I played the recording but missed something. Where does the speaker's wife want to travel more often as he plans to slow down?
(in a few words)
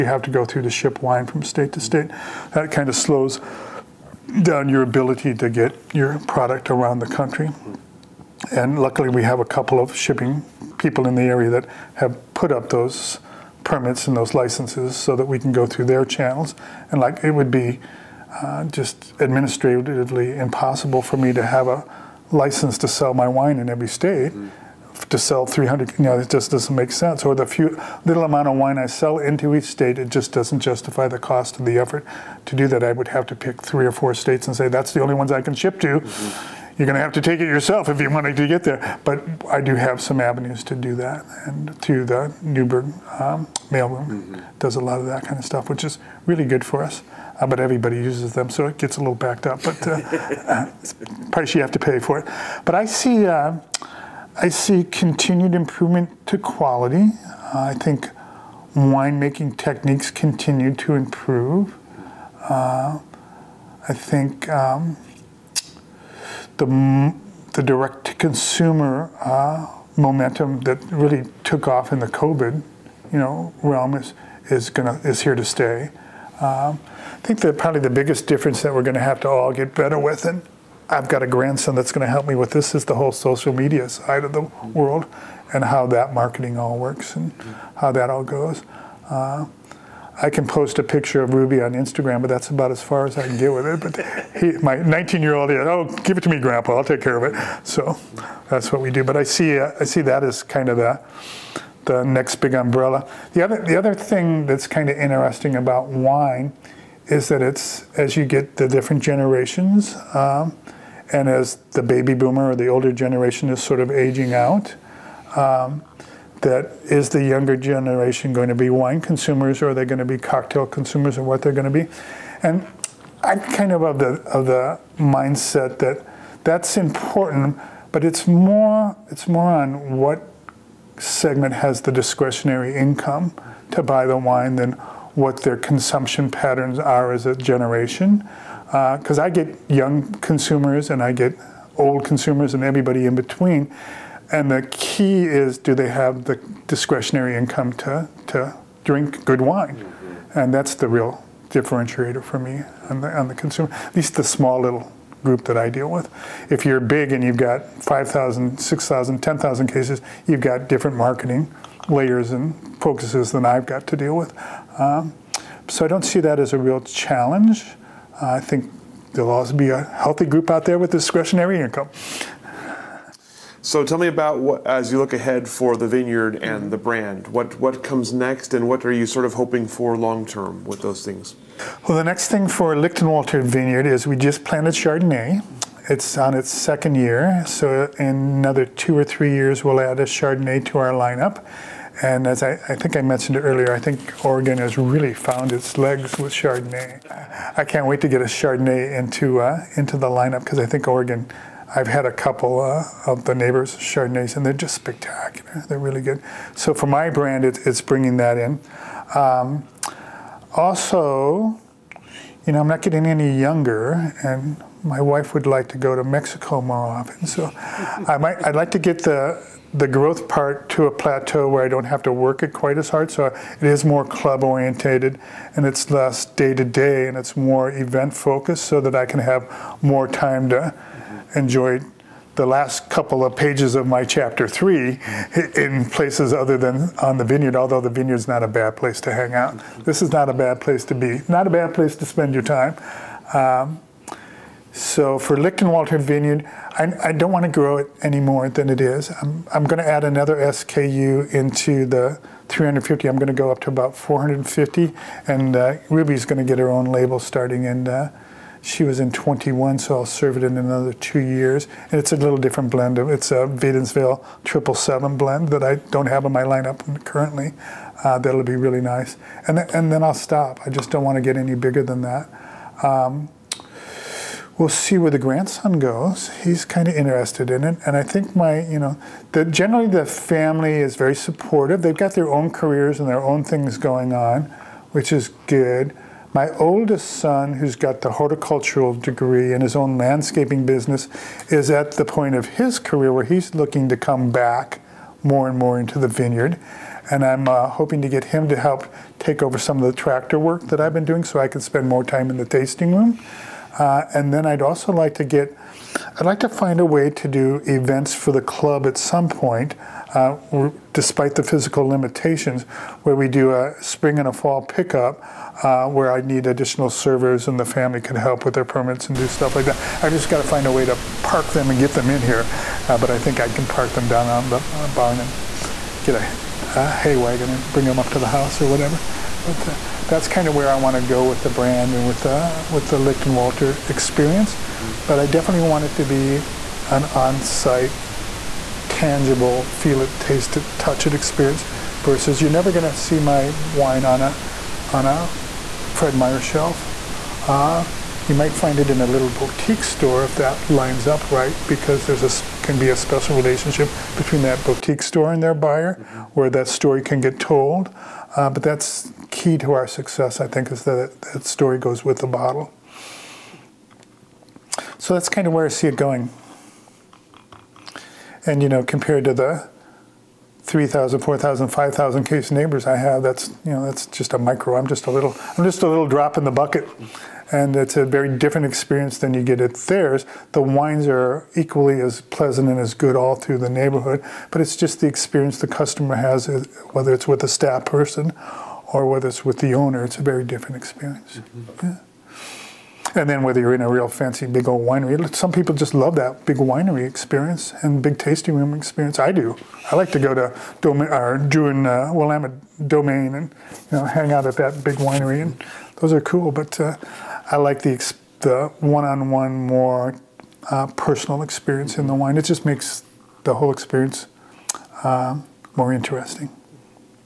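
Mexico.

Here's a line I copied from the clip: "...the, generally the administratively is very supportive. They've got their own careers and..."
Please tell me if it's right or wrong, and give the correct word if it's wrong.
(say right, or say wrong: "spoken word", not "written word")
wrong: "family", not "administratively".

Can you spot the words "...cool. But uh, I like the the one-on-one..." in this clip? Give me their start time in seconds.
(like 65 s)
406 s.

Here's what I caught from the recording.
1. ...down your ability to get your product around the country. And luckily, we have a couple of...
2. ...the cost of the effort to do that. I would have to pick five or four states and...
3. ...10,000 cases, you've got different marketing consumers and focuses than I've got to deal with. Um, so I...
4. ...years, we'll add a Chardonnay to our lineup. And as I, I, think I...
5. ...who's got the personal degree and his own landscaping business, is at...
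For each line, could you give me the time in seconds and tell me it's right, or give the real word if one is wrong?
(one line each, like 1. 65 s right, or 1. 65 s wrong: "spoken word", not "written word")
1. 4 s right
2. 31 s wrong: "three", not "five"
3. 159 s wrong: "layers", not "consumers"
4. 189 s right
5. 287 s wrong: "horticultural", not "personal".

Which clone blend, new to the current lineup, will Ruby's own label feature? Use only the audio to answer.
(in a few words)
Wadenswil 777.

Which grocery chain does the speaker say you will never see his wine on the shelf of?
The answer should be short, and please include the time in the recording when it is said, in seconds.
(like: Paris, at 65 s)
Fred Meyer, at 345 s.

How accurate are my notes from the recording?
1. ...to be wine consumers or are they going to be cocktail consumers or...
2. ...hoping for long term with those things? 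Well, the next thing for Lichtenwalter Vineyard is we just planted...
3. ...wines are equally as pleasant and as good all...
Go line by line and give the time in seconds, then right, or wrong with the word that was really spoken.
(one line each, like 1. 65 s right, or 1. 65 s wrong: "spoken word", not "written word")
1. 118 s right
2. 179 s right
3. 380 s right.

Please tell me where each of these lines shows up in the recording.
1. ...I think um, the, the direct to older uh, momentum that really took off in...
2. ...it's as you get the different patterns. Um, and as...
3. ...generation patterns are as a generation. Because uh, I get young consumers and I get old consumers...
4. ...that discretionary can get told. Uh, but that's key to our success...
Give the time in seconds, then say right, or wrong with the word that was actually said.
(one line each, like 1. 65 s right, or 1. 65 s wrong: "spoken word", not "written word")
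1. 63 s wrong: "consumer", not "older"
2. 107 s wrong: "generations", not "patterns"
3. 135 s wrong: "consumption", not "generation"
4. 356 s wrong: "story", not "discretionary".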